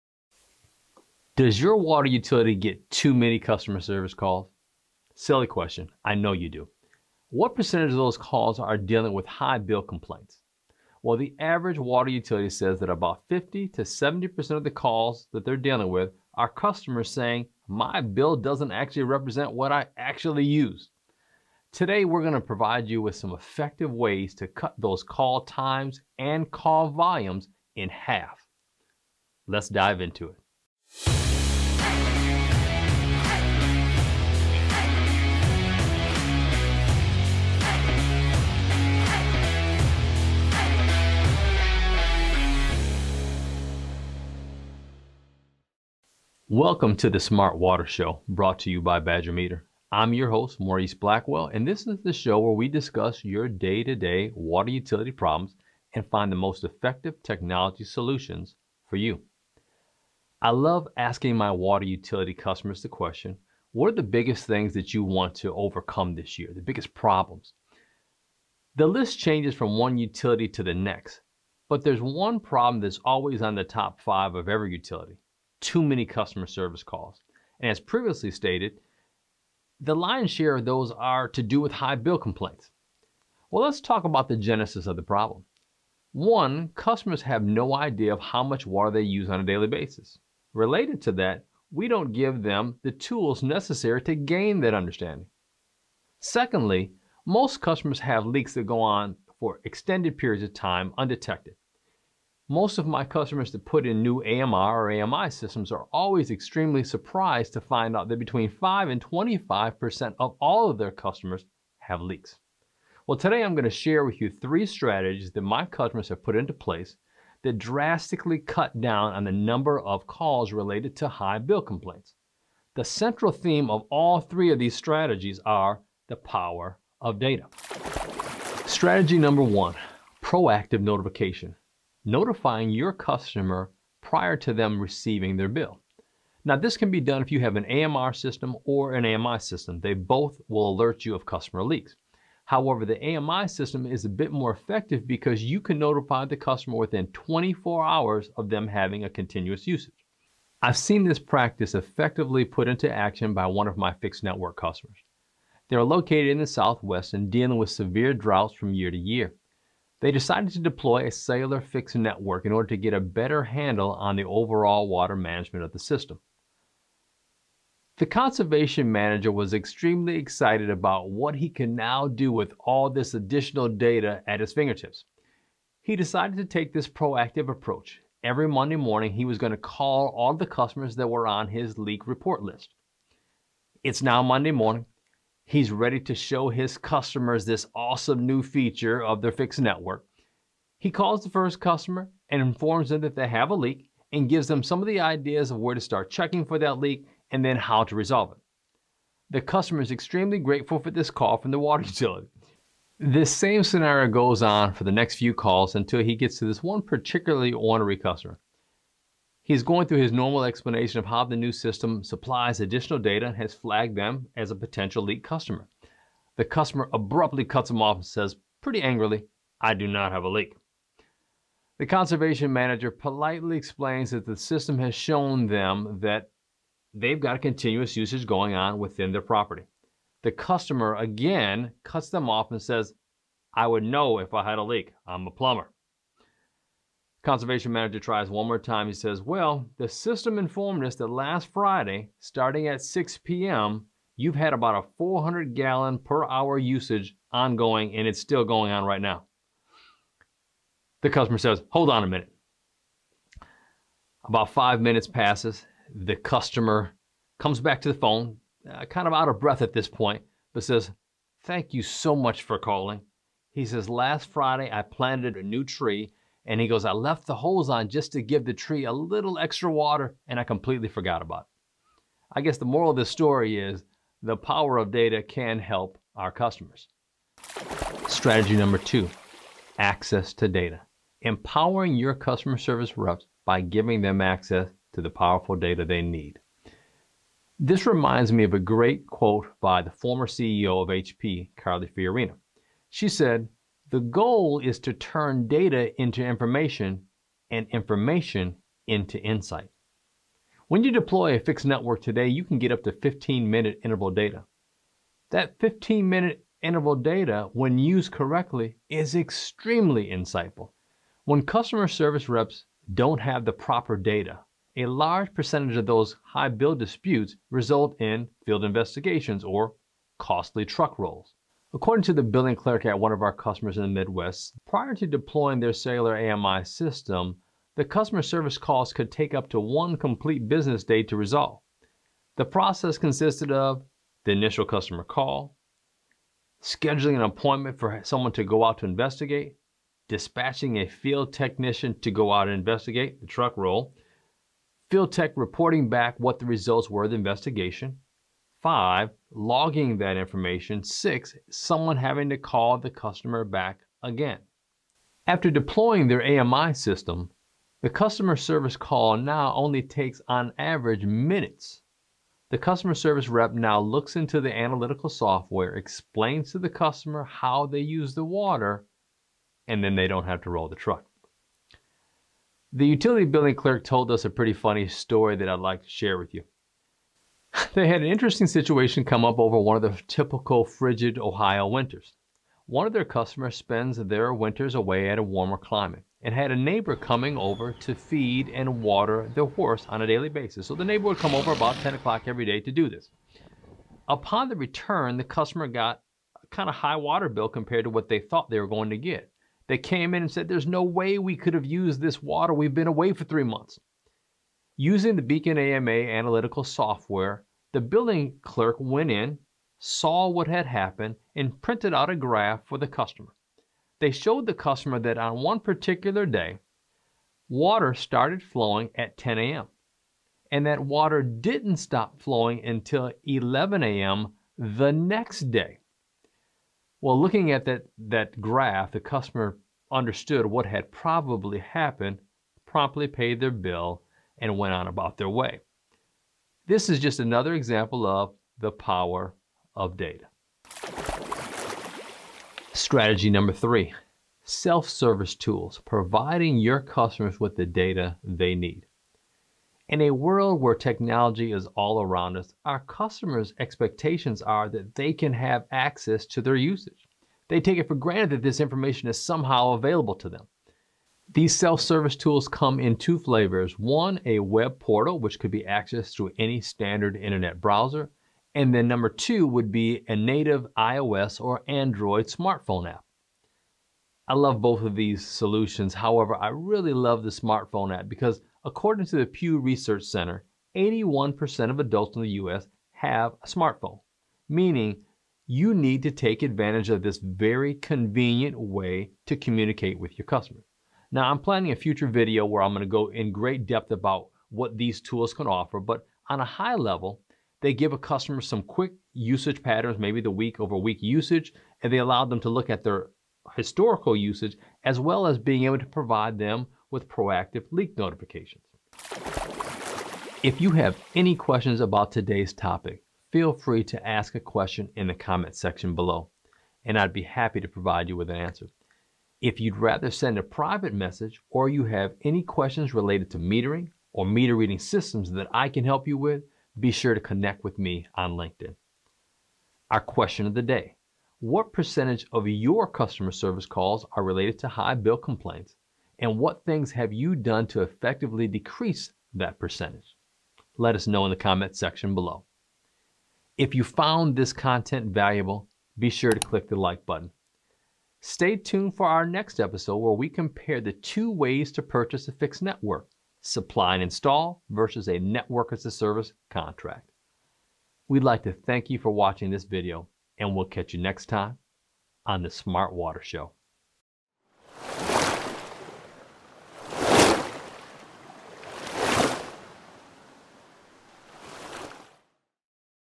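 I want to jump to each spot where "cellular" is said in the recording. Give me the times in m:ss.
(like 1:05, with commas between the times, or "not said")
2:41, 5:25.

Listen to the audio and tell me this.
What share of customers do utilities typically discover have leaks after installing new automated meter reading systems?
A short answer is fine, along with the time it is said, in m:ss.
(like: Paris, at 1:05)
5 to 25%, at 1:48.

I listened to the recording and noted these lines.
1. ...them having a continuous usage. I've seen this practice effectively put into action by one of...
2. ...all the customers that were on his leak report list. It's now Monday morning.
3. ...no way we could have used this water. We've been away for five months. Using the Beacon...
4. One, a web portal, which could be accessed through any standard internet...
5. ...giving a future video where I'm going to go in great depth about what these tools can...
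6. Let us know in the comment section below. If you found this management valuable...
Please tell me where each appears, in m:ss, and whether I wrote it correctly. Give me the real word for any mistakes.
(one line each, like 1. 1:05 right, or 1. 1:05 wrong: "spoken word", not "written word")
1. 2:28 right
2. 3:00 right
3. 6:40 wrong: "three", not "five"
4. 7:43 right
5. 8:11 wrong: "planning", not "giving"
6. 9:00 wrong: "content", not "management".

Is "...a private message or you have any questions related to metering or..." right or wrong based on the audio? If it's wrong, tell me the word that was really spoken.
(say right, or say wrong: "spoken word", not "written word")
right.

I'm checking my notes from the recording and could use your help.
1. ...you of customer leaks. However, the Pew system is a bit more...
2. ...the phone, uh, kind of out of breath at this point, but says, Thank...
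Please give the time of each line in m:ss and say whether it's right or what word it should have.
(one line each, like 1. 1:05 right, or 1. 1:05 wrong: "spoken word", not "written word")
1. 2:21 wrong: "AMI", not "Pew"
2. 4:17 right.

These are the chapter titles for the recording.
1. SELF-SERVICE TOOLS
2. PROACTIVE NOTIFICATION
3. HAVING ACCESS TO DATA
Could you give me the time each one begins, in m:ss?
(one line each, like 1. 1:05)
1. 7:22
2. 2:09
3. 4:39.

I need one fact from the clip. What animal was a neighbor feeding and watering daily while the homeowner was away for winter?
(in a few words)
horse.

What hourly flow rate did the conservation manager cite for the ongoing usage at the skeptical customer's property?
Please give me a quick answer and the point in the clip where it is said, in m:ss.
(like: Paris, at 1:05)
400 gallons per hour, at 4:04.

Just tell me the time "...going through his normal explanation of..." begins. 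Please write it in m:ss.
3:29.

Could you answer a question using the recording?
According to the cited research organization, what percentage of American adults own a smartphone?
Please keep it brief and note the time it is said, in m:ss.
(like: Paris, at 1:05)
81%, at 8:00.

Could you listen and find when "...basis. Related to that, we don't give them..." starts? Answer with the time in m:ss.
1:29.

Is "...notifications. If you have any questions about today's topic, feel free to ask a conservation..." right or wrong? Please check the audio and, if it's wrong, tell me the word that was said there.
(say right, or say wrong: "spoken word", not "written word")
wrong: "question", not "conservation".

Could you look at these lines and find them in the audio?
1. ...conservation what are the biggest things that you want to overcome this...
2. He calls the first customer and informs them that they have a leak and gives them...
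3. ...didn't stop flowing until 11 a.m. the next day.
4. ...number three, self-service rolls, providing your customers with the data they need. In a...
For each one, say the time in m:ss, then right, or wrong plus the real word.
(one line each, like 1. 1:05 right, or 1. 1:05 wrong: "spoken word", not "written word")
1. 1:02 wrong: "question", not "conservation"
2. 3:10 right
3. 7:01 right
4. 7:23 wrong: "tools", not "rolls".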